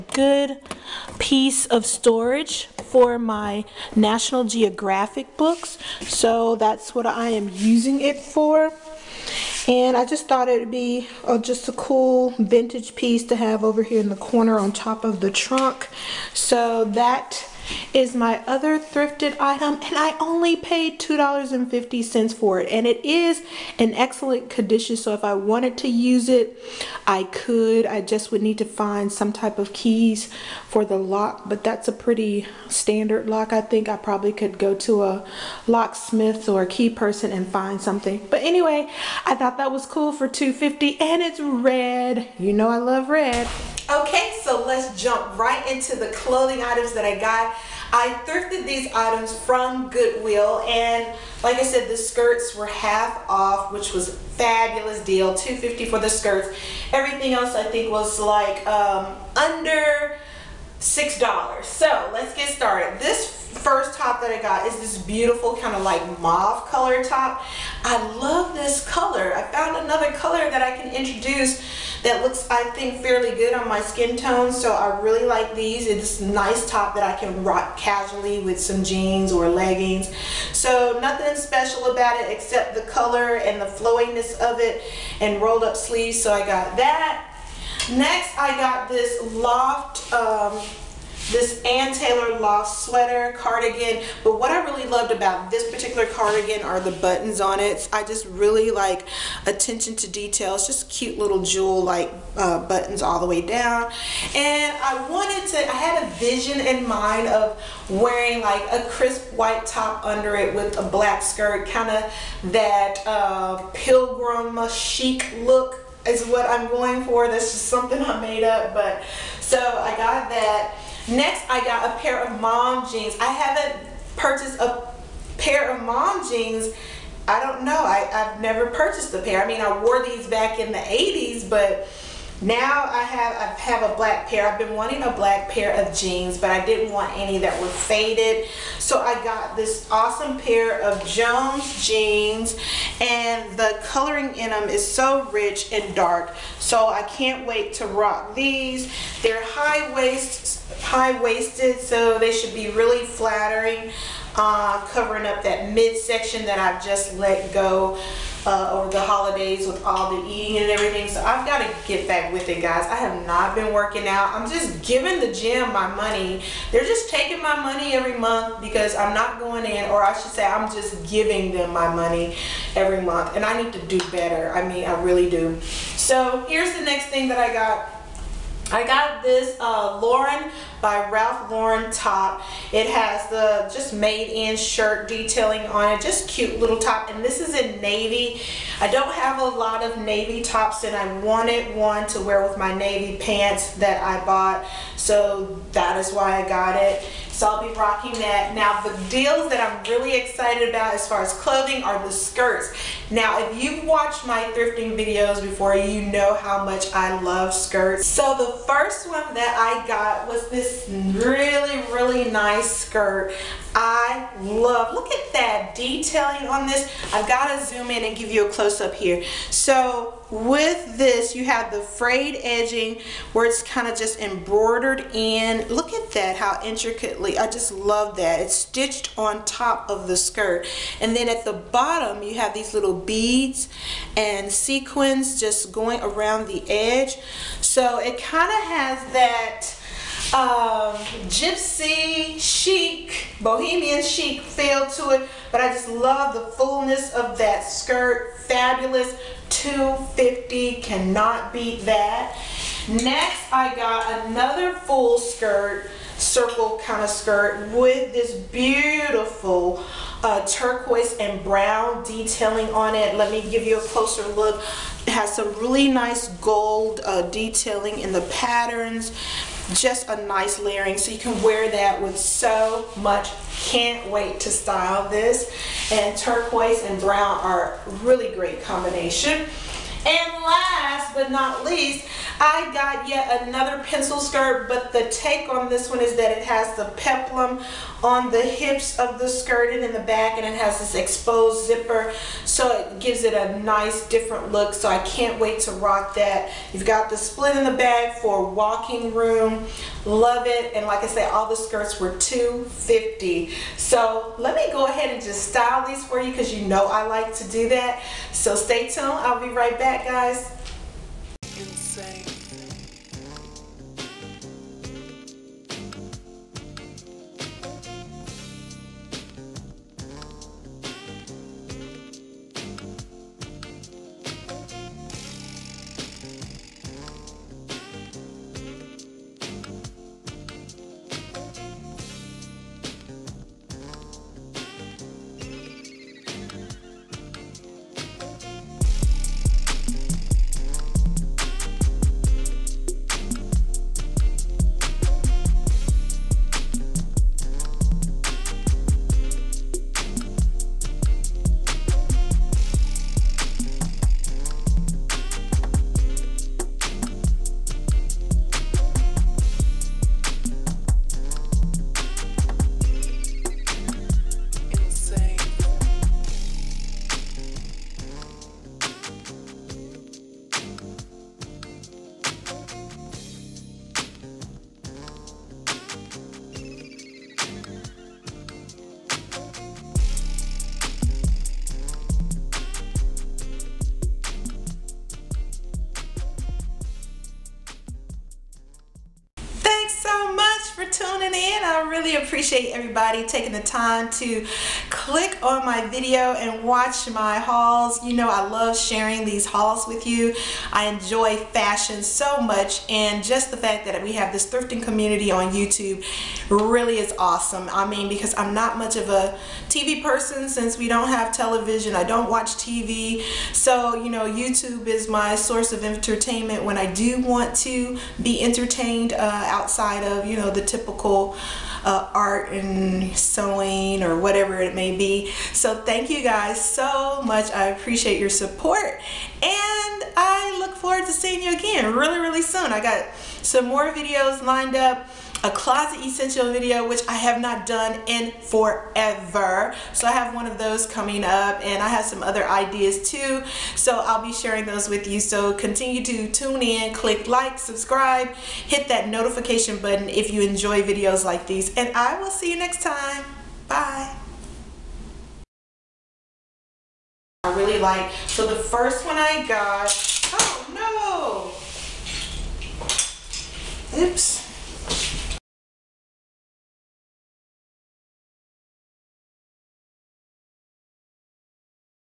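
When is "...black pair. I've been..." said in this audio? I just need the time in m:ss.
2:13.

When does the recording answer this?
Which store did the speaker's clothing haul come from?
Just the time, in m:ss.
0:49.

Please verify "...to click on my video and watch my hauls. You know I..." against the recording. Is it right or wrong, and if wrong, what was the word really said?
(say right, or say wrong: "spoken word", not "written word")
right.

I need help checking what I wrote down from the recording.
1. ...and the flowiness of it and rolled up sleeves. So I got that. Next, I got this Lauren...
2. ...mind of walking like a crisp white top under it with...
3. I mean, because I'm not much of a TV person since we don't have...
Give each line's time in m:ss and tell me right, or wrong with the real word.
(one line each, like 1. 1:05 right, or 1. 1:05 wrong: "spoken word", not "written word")
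1. 1:23 wrong: "Loft", not "Lauren"
2. 1:46 wrong: "wearing", not "walking"
3. 6:47 right.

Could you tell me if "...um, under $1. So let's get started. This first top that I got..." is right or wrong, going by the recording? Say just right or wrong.
wrong.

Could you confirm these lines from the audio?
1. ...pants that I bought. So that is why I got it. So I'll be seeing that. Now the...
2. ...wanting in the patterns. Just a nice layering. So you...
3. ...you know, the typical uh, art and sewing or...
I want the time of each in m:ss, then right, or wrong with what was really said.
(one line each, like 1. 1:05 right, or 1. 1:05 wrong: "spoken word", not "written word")
1. 3:13 wrong: "rocking", not "seeing"
2. 4:27 wrong: "detailing", not "wanting"
3. 7:00 right.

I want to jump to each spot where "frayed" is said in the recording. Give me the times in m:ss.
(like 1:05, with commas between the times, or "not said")
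3:41.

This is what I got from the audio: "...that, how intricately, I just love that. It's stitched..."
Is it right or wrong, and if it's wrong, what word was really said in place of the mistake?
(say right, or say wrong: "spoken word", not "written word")
right.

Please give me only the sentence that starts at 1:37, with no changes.
I just really like attention to details, just cute little jewel like uh, buttons all the way down.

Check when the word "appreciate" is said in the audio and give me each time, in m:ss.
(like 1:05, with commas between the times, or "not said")
6:32, 7:07.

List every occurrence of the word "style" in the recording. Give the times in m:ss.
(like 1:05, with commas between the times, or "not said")
4:34, 5:05.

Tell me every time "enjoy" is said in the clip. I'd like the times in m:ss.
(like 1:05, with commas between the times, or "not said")
6:40, 7:30.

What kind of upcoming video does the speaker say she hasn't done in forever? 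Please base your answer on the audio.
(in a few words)
Closet essential video.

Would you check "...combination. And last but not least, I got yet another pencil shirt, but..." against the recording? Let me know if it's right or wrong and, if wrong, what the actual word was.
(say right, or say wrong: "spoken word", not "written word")
wrong: "skirt", not "shirt".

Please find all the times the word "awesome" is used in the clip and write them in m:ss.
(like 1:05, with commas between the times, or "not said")
2:19, 6:47.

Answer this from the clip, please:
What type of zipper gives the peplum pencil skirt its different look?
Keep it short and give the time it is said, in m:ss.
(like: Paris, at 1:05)
Exposed zipper, at 4:50.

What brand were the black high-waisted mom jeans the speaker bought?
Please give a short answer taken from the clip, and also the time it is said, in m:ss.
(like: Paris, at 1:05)
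Jones, at 2:21.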